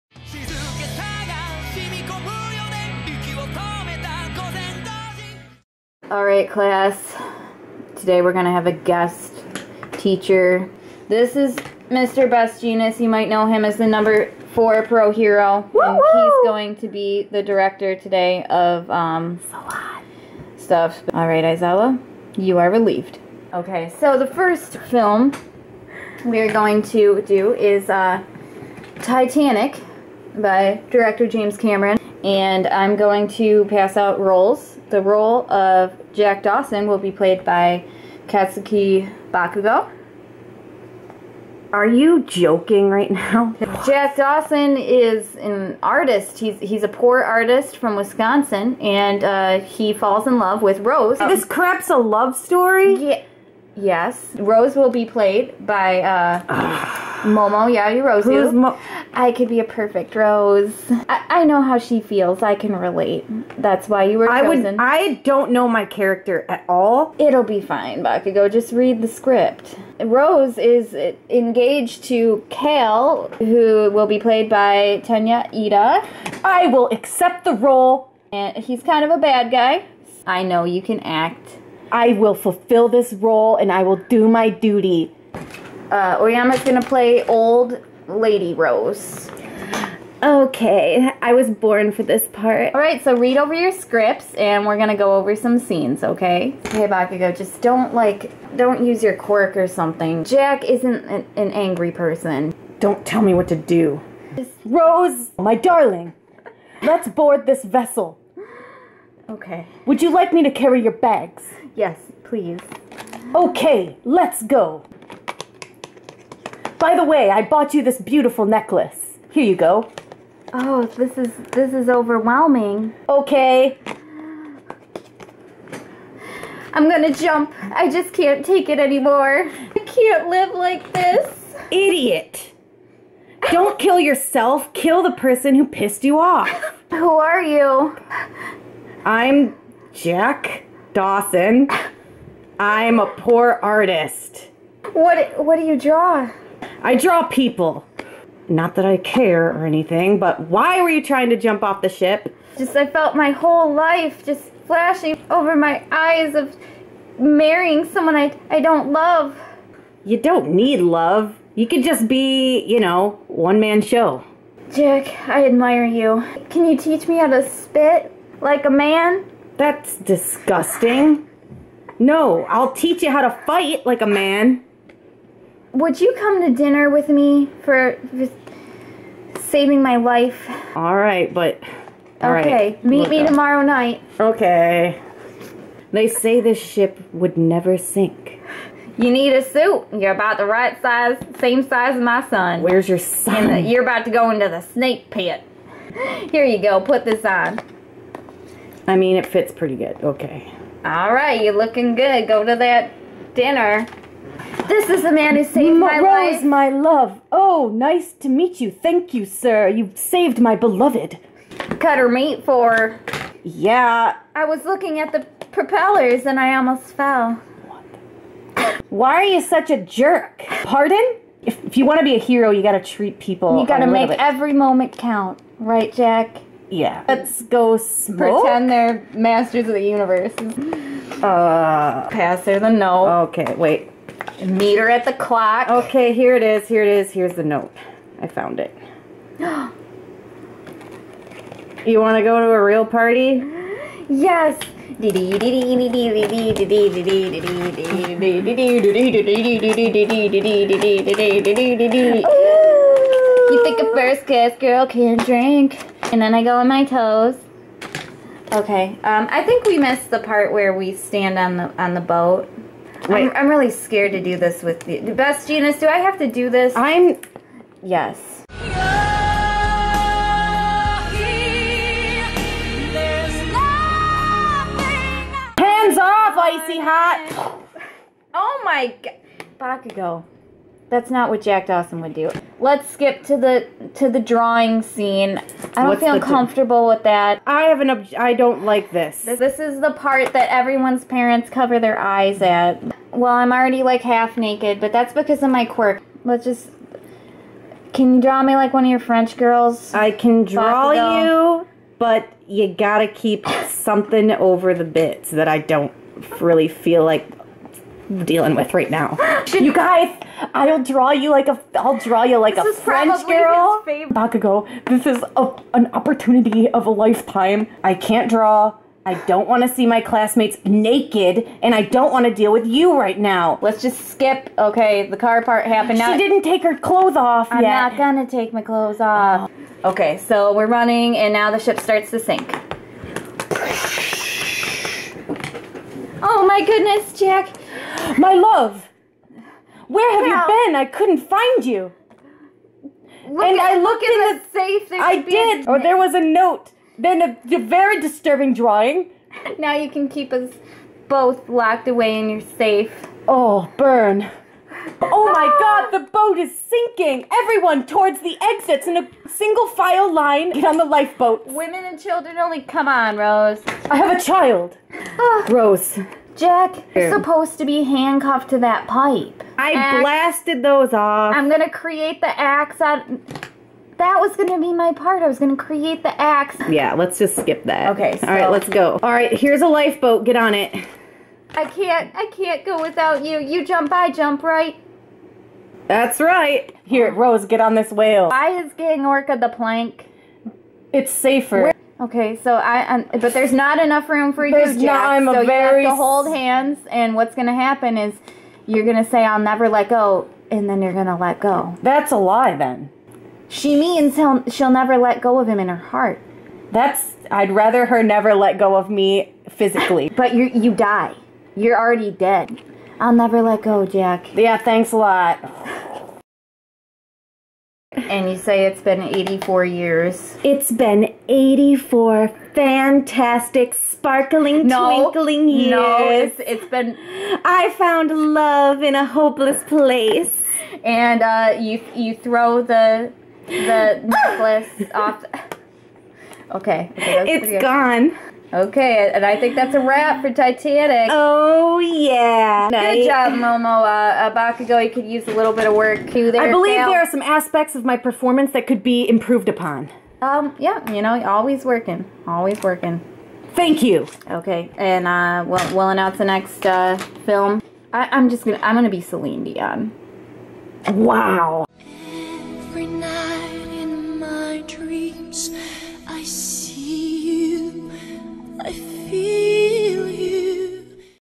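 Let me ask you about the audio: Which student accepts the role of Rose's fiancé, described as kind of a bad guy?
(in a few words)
Tenya Iida.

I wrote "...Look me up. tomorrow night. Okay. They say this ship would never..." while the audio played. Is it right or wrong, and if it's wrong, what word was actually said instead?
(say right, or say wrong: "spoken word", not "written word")
right.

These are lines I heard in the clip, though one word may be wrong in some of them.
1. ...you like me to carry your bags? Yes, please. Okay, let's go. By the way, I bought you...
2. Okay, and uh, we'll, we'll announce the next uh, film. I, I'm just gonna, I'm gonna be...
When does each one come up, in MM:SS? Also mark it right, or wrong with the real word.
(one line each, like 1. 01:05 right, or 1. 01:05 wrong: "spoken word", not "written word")
1. 01:50 right
2. 07:34 right.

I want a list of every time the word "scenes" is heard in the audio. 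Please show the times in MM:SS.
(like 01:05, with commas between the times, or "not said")
01:35, 04:44.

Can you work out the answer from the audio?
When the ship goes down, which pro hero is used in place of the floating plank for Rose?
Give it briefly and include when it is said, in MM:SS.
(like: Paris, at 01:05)
Gang Orca, at 06:28.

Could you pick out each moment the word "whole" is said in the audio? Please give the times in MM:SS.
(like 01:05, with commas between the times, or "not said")
02:33.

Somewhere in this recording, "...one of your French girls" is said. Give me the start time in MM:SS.
04:58.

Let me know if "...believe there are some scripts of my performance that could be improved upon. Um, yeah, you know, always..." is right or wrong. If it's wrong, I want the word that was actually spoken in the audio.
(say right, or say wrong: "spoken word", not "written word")
wrong: "aspects", not "scripts".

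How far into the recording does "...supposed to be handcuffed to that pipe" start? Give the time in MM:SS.
06:07.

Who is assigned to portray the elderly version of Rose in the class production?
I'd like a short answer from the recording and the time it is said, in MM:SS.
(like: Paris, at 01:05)
Aoyama, at 01:26.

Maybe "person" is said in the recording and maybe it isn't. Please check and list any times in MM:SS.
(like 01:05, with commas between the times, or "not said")
01:41, 02:15.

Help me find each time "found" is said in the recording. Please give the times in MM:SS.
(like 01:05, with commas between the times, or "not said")
03:58, 07:07.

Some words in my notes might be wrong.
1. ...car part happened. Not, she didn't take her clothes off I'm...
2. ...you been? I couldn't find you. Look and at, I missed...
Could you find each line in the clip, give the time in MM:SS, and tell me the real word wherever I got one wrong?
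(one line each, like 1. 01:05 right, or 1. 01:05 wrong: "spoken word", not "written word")
1. 05:25 right
2. 05:40 wrong: "looked", not "missed".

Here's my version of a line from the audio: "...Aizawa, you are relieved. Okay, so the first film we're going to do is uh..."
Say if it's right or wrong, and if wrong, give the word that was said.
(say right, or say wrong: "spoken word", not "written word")
right.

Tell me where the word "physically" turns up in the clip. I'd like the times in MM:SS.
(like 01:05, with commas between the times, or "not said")
06:49.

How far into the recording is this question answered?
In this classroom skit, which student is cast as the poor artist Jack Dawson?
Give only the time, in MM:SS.
00:38.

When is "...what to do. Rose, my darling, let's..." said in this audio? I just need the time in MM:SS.
01:43.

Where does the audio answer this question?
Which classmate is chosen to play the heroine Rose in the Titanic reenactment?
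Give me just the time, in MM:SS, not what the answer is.
00:57.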